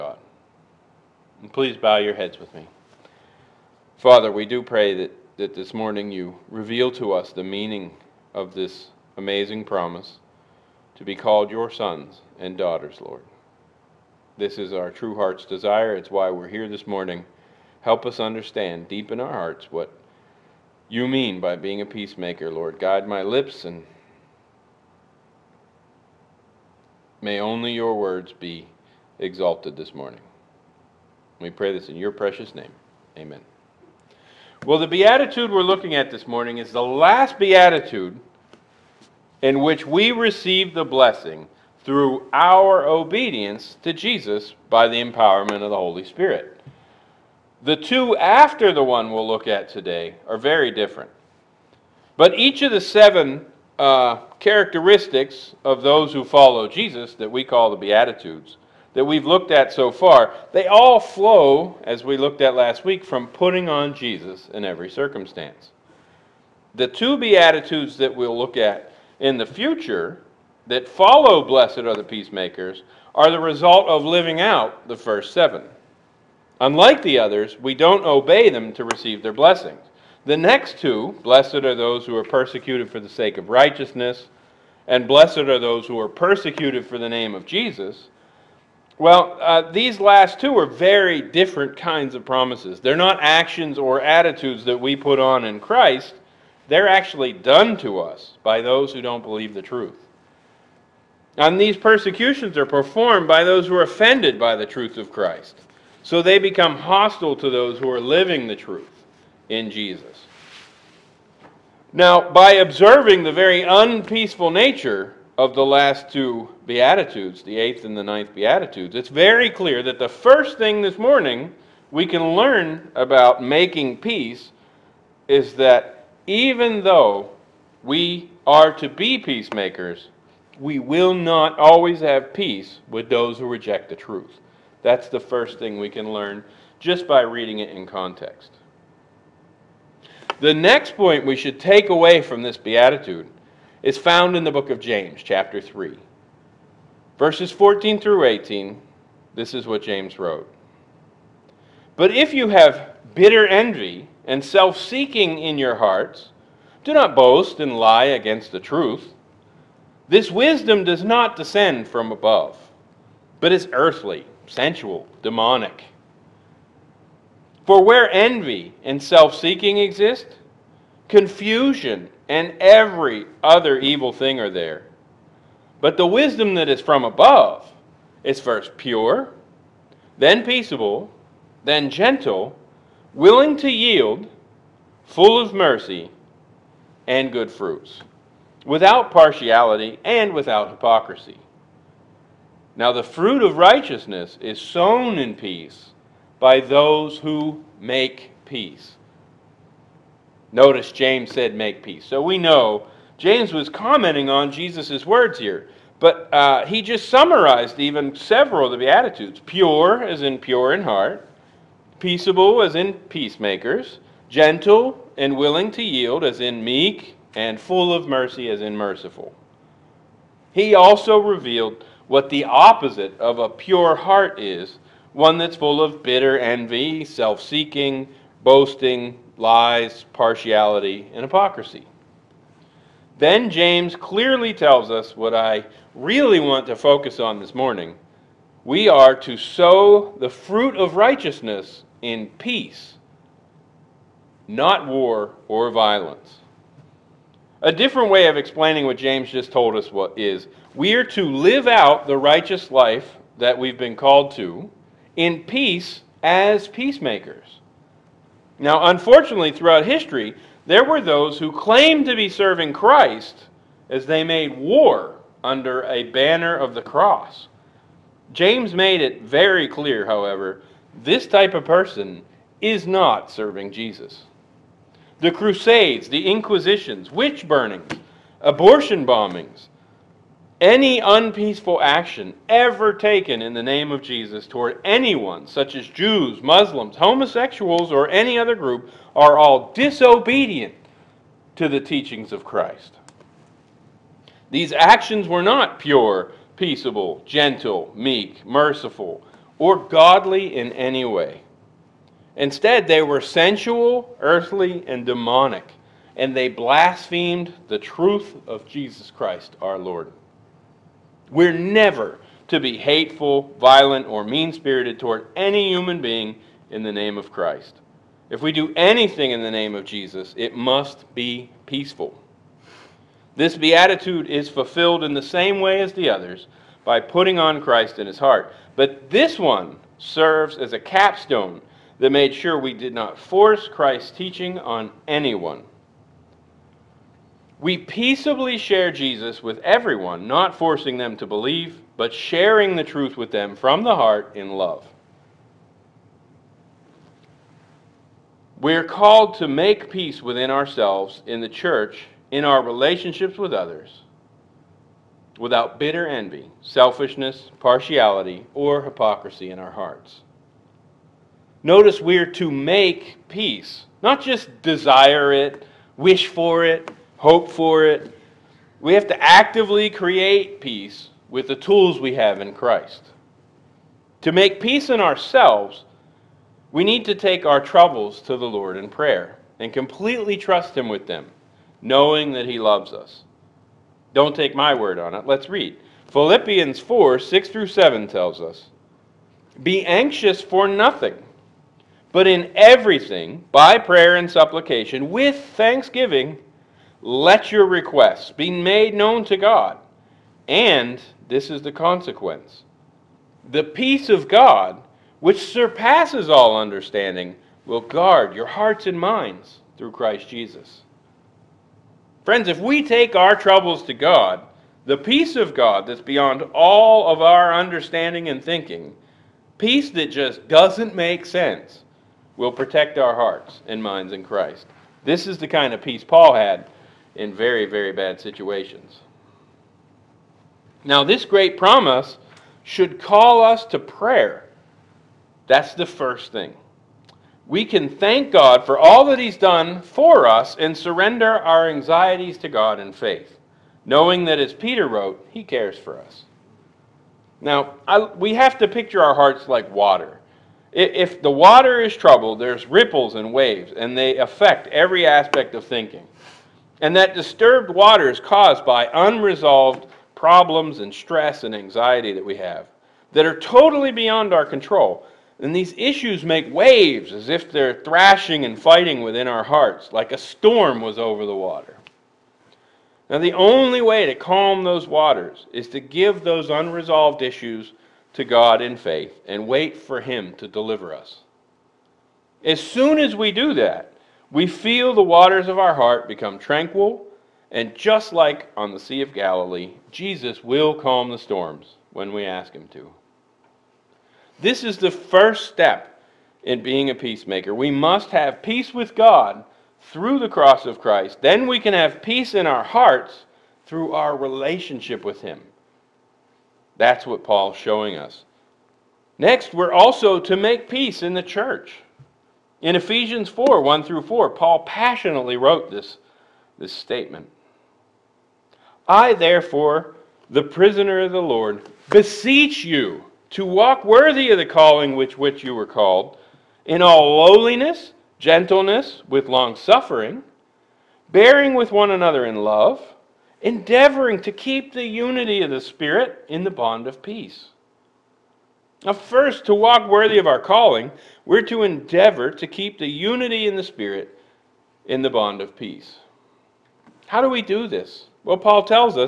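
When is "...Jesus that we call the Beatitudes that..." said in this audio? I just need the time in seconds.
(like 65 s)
56 s.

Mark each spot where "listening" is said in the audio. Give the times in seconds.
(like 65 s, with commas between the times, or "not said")
not said.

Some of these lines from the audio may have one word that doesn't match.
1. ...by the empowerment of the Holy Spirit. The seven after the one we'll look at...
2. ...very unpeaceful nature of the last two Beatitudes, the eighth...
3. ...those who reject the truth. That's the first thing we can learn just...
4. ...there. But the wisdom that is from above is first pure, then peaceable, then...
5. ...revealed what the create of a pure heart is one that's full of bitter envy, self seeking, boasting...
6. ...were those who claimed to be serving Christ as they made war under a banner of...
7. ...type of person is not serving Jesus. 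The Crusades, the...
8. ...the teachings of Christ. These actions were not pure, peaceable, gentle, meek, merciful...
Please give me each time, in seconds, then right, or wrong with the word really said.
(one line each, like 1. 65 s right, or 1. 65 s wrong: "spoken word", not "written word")
1. 44 s wrong: "two", not "seven"
2. 113 s right
3. 133 s right
4. 174 s right
5. 221 s wrong: "opposite", not "create"
6. 260 s right
7. 271 s right
8. 291 s right.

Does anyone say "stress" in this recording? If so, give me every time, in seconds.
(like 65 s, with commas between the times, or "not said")
460 s.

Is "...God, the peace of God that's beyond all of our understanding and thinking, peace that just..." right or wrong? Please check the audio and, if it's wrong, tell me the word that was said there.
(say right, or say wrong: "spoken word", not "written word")
right.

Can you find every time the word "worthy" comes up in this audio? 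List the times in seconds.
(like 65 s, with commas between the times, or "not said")
523 s, 539 s.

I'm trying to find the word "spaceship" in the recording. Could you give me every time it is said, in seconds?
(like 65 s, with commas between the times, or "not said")
not said.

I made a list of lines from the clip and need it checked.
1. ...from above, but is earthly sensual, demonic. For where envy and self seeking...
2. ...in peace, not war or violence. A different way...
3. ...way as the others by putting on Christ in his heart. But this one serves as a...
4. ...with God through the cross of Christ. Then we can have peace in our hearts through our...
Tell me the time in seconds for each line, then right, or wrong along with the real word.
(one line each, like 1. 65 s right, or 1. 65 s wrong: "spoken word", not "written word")
1. 161 s right
2. 242 s right
3. 325 s right
4. 498 s right.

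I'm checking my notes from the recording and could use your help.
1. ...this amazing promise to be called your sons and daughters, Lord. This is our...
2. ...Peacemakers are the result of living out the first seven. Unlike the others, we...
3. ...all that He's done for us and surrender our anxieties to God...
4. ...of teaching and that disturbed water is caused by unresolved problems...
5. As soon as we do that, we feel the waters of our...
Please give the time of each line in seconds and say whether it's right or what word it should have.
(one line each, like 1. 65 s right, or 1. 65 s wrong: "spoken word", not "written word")
1. 8 s right
2. 72 s right
3. 438 s right
4. 455 s wrong: "thinking", not "teaching"
5. 482 s right.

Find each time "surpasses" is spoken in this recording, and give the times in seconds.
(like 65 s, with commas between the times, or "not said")
405 s.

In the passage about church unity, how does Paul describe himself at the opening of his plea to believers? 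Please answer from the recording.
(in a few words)
the prisoner of the Lord.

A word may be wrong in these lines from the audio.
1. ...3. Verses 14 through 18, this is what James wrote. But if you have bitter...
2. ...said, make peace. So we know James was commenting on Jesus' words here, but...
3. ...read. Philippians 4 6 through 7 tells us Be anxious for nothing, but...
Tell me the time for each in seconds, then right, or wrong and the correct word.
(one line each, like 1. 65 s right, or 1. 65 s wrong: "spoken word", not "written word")
1. 145 s right
2. 201 s right
3. 385 s right.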